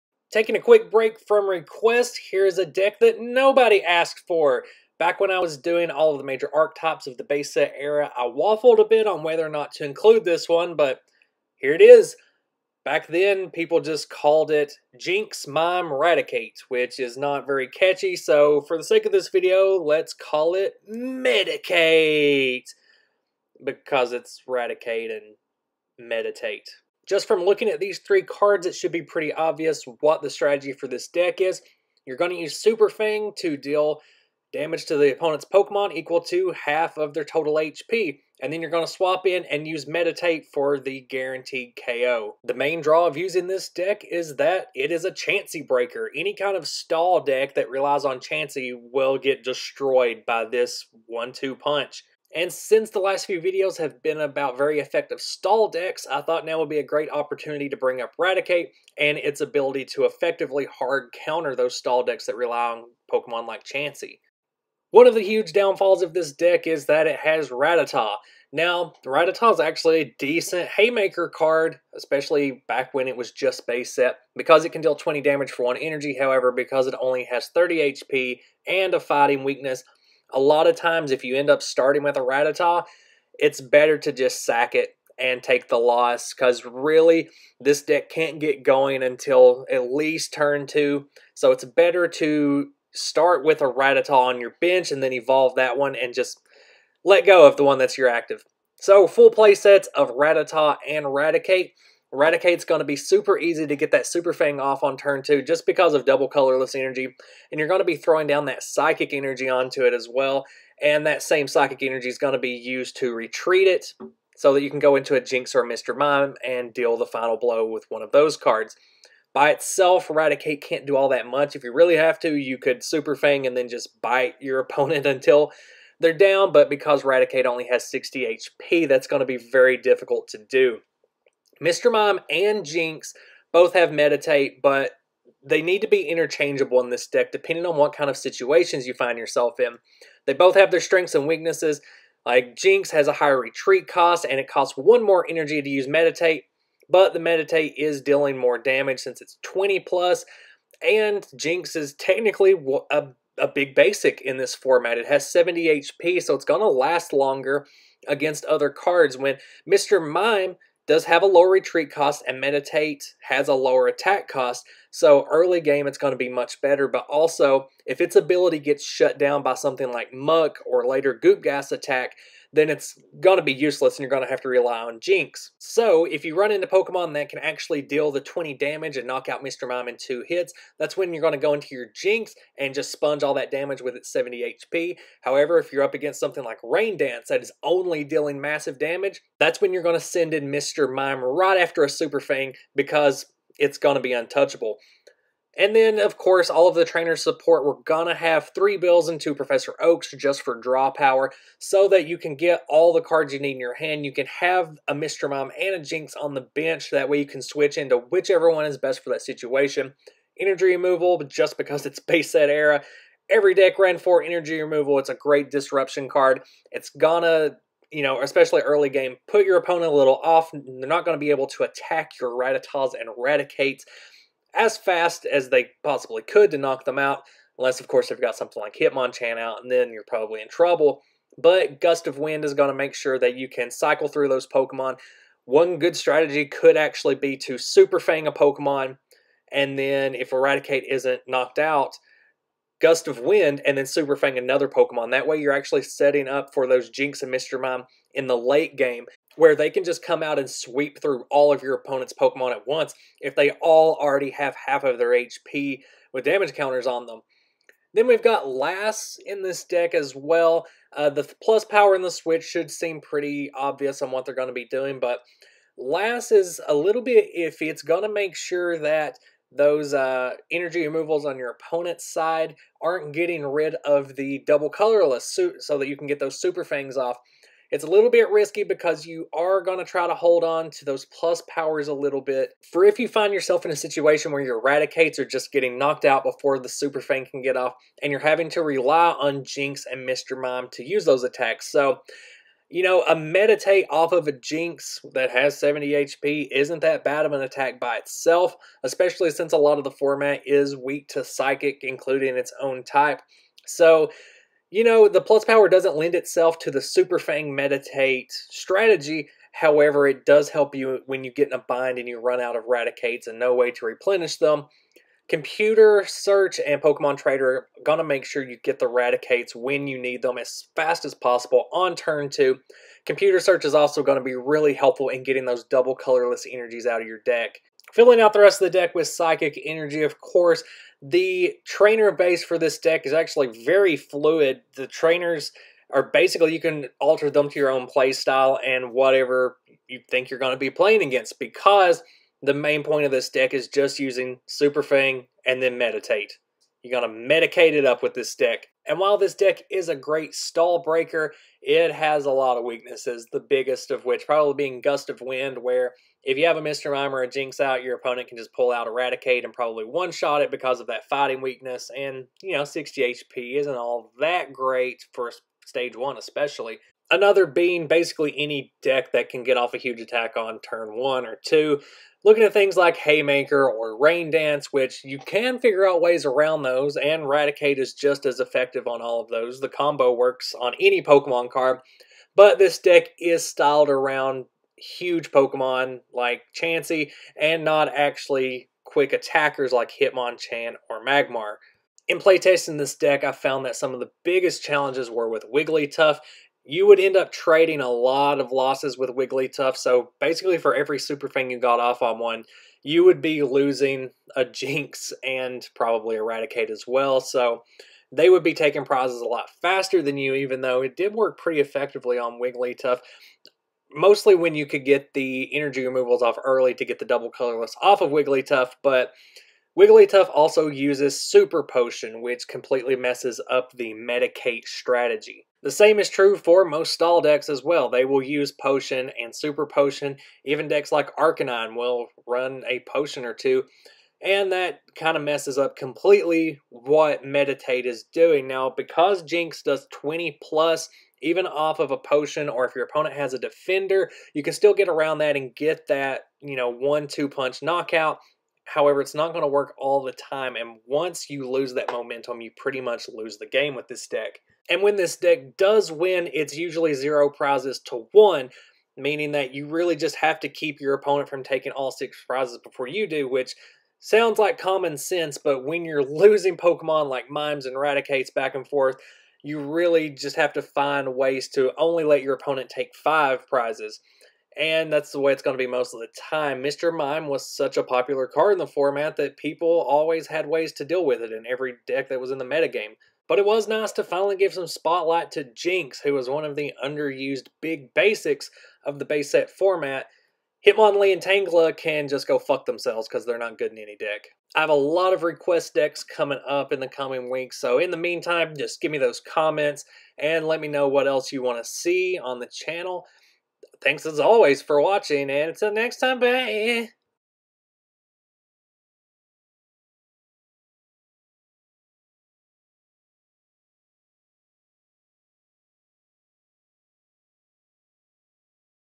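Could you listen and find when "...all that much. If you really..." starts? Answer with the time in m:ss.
2:00.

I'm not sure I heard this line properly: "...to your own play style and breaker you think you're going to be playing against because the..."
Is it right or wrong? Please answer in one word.
wrong.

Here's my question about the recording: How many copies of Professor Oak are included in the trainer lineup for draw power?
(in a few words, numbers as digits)
2.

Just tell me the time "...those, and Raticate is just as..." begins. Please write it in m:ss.
6:16.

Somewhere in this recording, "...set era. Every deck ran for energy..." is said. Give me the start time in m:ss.
3:32.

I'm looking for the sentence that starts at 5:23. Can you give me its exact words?
Computer Search is also going to be really helpful in getting those double colorless energies out of your deck.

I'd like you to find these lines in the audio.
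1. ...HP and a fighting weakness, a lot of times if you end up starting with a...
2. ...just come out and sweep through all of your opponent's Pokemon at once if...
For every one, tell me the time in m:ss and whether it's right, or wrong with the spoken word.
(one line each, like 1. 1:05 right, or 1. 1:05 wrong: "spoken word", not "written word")
1. 1:17 right
2. 4:09 right.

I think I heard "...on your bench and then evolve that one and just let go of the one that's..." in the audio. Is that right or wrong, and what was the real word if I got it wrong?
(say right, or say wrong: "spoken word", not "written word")
right.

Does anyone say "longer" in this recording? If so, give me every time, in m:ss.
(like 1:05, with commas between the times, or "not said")
2:37.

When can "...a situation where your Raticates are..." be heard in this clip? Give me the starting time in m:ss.
4:43.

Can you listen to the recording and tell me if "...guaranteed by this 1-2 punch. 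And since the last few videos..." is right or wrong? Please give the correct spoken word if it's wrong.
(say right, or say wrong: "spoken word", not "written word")
wrong: "destroyed", not "guaranteed".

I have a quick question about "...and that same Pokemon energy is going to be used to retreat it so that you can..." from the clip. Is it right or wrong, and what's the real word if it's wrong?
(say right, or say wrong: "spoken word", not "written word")
wrong: "Psychic", not "Pokemon".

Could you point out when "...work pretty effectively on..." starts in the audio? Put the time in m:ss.
6:51.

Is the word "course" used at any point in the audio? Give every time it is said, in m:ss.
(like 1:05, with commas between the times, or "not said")
3:16, 3:47, 5:30.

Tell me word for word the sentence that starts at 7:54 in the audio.
And that's the way it's going to be most of the time.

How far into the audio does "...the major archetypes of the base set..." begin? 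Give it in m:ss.
0:06.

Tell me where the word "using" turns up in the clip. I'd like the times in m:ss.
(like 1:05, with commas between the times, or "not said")
0:43, 5:43.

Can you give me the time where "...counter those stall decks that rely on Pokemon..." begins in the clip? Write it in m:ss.
1:01.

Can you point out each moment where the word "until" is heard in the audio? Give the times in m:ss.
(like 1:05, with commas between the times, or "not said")
1:29, 2:05, 8:25.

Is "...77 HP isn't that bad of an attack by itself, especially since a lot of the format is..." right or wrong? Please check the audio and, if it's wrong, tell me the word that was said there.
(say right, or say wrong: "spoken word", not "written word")
wrong: "70", not "77".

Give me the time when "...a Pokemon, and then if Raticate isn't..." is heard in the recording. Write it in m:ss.
3:58.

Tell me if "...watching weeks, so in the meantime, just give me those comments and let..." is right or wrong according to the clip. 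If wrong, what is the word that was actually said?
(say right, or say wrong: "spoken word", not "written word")
wrong: "coming", not "watching".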